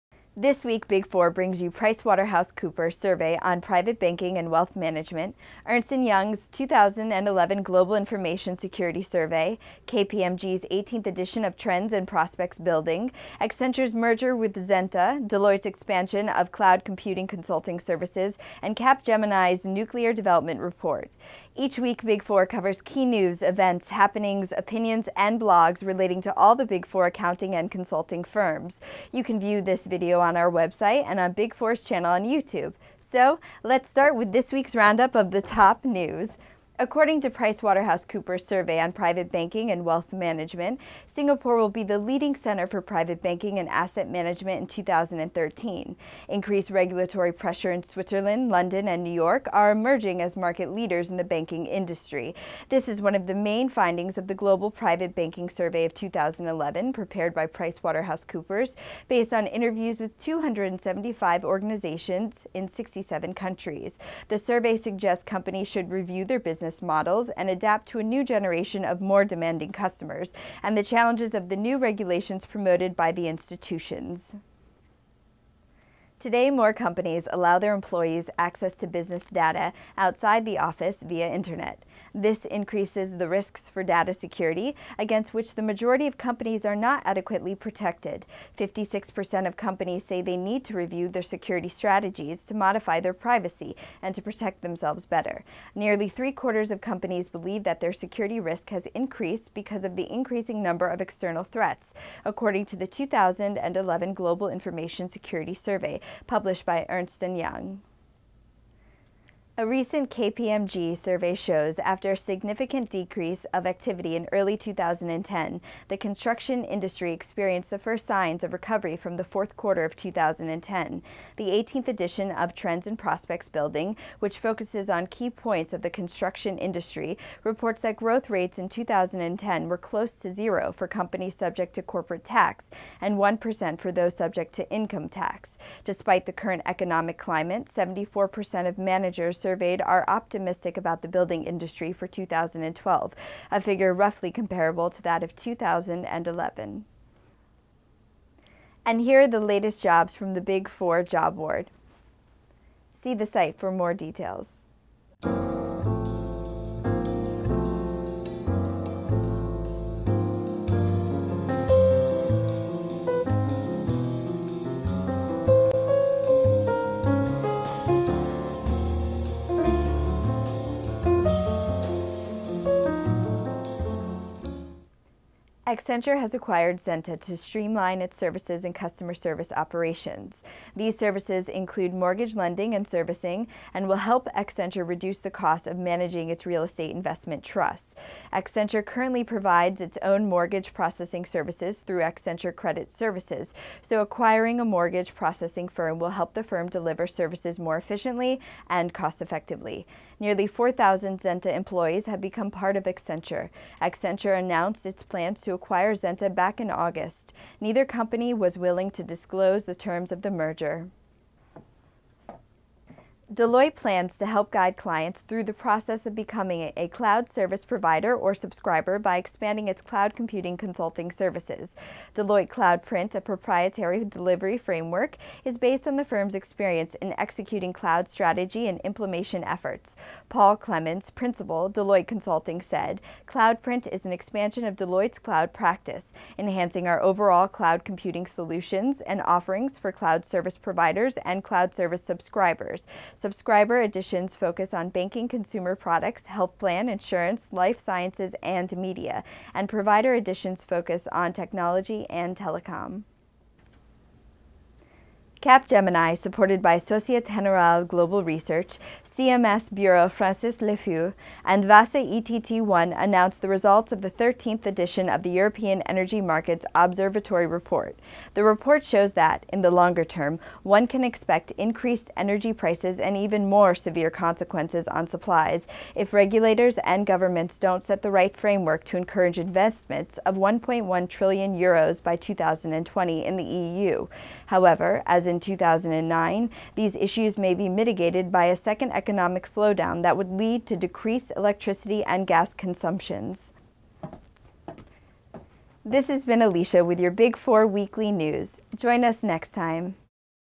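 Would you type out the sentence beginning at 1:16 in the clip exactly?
Today, more companies allow their employees access to business data outside the office via internet.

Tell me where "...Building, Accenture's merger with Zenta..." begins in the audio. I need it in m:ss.
0:12.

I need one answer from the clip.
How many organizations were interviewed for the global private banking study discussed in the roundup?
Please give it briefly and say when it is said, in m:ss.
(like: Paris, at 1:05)
275, at 1:00.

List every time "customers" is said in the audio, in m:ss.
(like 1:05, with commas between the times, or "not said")
1:09, 2:58.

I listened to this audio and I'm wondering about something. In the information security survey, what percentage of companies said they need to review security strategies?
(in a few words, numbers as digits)
56%.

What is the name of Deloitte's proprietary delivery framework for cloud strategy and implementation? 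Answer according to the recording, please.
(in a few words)
Deloitte CloudPrint.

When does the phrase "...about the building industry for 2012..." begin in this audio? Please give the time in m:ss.
2:20.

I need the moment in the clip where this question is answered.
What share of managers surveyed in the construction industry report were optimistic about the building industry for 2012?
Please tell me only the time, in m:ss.
2:17.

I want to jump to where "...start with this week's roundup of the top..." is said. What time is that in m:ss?
0:33.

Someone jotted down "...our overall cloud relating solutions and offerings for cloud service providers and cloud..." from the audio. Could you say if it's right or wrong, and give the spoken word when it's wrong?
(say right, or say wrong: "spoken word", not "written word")
wrong: "computing", not "relating".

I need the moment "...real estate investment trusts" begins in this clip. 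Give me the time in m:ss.
3:06.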